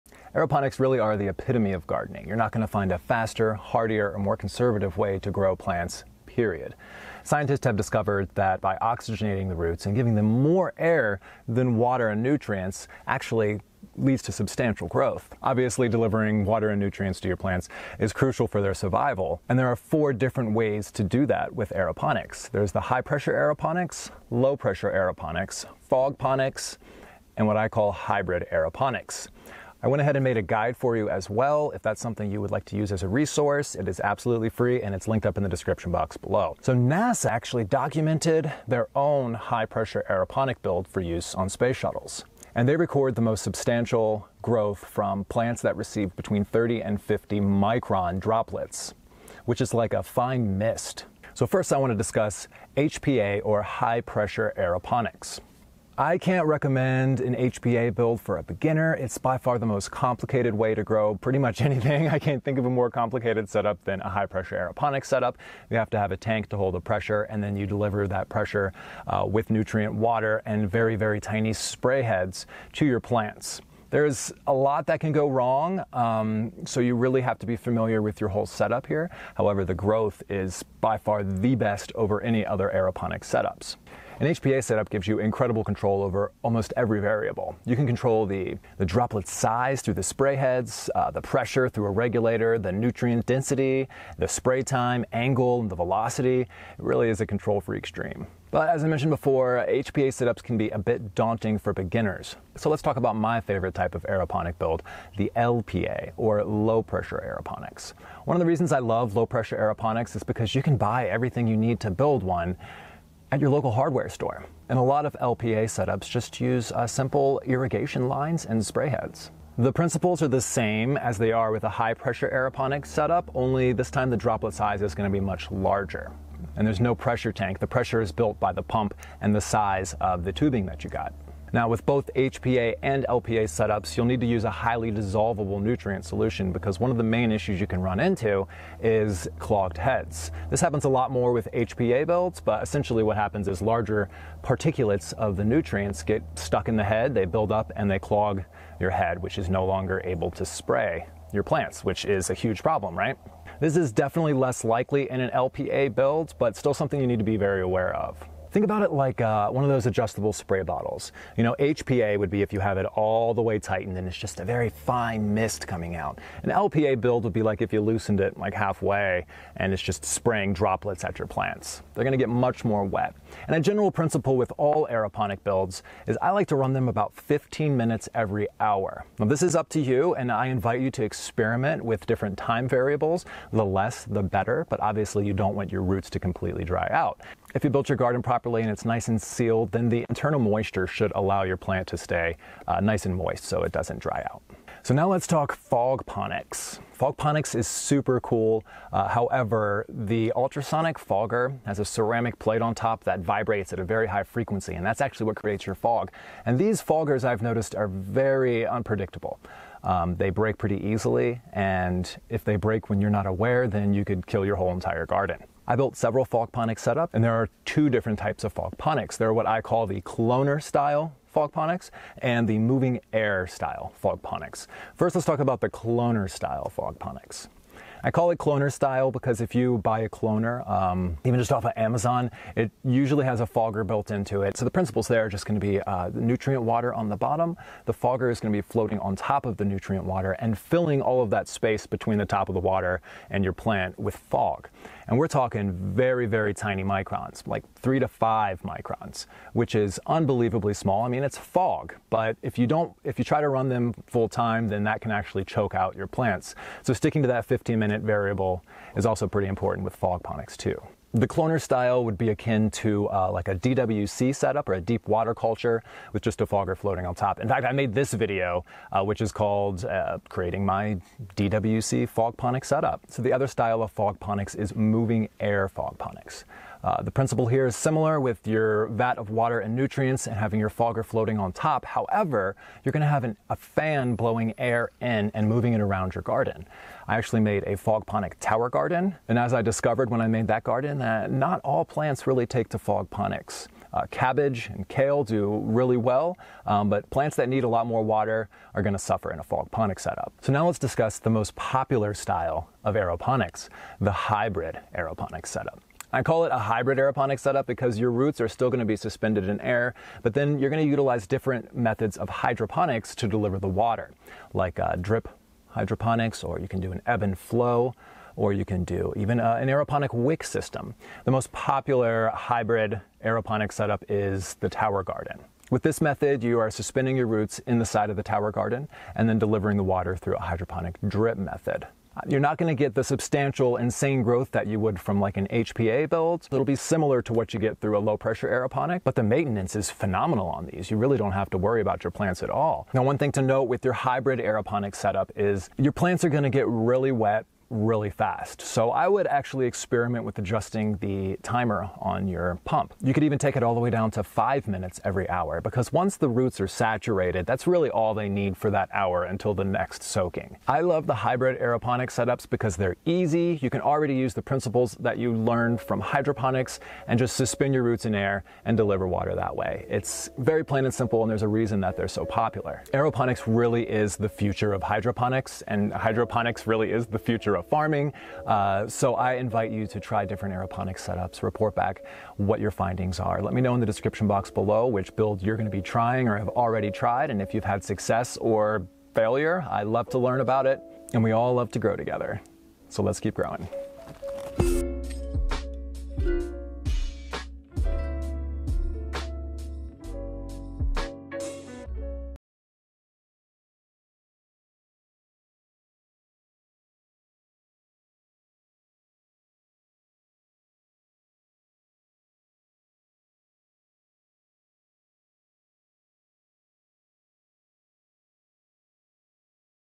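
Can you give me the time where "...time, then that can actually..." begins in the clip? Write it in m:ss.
4:14.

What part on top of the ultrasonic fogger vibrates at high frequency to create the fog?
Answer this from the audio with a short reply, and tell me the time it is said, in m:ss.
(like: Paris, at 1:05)
A ceramic plate, at 3:21.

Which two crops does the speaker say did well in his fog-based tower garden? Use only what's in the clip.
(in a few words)
Cabbage and kale.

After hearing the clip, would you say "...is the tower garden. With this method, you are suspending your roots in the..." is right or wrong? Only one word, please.
right.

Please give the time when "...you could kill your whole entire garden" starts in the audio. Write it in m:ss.
3:33.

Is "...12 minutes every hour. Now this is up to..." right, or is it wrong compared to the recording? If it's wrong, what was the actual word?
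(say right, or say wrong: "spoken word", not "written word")
wrong: "15", not "12".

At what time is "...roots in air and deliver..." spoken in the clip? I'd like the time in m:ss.
6:07.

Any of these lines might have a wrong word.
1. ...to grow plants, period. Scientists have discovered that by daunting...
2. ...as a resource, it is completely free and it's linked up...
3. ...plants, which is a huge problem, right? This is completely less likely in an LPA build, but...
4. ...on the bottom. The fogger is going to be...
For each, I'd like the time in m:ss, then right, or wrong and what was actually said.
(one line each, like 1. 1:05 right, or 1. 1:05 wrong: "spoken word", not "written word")
1. 0:05 wrong: "oxygenating", not "daunting"
2. 0:32 wrong: "absolutely", not "completely"
3. 2:31 wrong: "definitely", not "completely"
4. 3:56 right.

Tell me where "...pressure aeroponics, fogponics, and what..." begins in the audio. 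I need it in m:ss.
0:24.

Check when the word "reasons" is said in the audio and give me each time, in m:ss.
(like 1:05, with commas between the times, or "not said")
1:48, 6:11.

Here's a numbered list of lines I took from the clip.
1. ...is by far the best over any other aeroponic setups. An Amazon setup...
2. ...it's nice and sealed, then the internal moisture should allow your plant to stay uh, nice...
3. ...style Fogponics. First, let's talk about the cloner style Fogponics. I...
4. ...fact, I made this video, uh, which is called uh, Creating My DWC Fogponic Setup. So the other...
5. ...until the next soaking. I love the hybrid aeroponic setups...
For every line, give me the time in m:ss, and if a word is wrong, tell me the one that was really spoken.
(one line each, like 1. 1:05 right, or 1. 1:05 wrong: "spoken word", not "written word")
1. 1:20 wrong: "HPA", not "Amazon"
2. 3:08 right
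3. 3:43 right
4. 4:27 right
5. 5:59 right.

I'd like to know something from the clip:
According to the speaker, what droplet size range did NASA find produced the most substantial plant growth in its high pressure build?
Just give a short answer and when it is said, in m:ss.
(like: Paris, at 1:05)
30 to 50 microns, at 0:46.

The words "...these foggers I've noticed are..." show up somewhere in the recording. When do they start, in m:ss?
3:26.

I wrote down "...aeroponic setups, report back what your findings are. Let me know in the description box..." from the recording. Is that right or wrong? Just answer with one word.
right.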